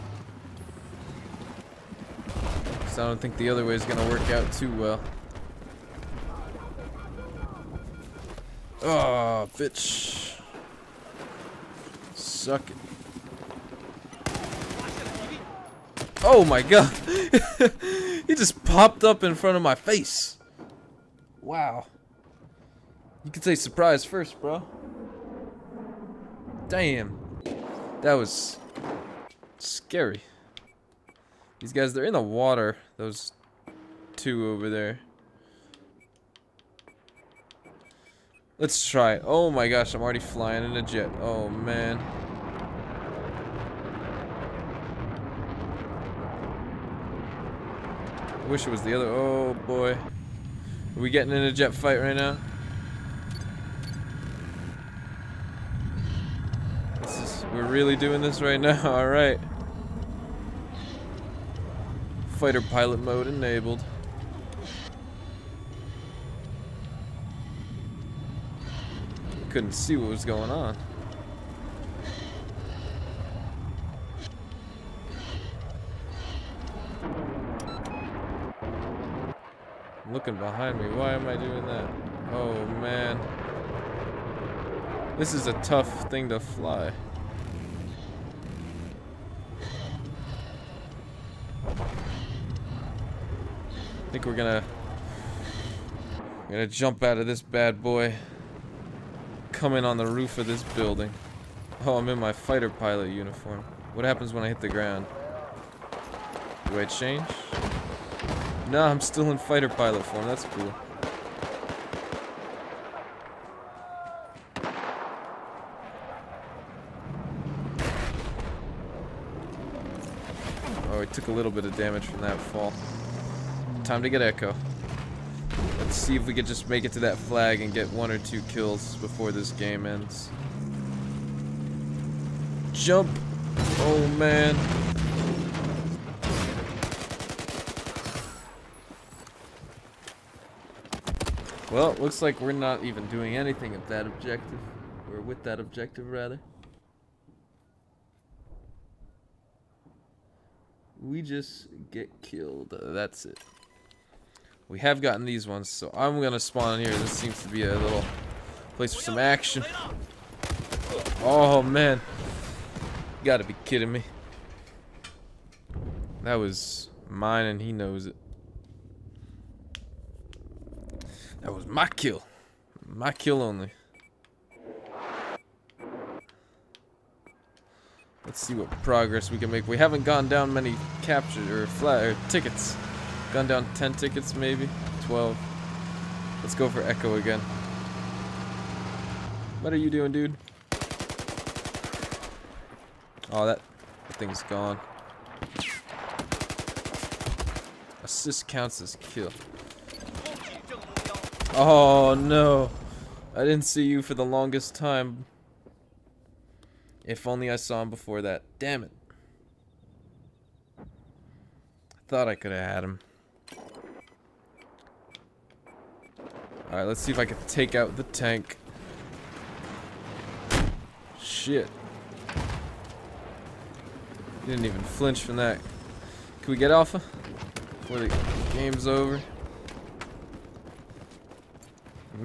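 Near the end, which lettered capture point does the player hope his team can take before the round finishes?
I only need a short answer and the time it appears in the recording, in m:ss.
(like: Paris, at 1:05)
Alpha, at 3:46.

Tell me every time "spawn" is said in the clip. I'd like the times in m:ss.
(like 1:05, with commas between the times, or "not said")
2:36.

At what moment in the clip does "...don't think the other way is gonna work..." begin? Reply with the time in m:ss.
0:03.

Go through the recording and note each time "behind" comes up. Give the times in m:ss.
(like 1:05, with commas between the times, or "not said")
1:20.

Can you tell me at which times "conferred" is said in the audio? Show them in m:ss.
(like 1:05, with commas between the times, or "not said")
not said.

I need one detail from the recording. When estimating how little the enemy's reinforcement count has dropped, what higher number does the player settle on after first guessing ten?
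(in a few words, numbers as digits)
12.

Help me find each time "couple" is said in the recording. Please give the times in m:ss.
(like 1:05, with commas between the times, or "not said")
not said.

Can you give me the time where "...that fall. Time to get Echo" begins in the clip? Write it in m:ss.
2:02.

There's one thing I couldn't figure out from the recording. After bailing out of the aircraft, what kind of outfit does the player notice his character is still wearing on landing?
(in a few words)
fighter pilot uniform.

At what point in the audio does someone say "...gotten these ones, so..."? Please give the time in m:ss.
2:35.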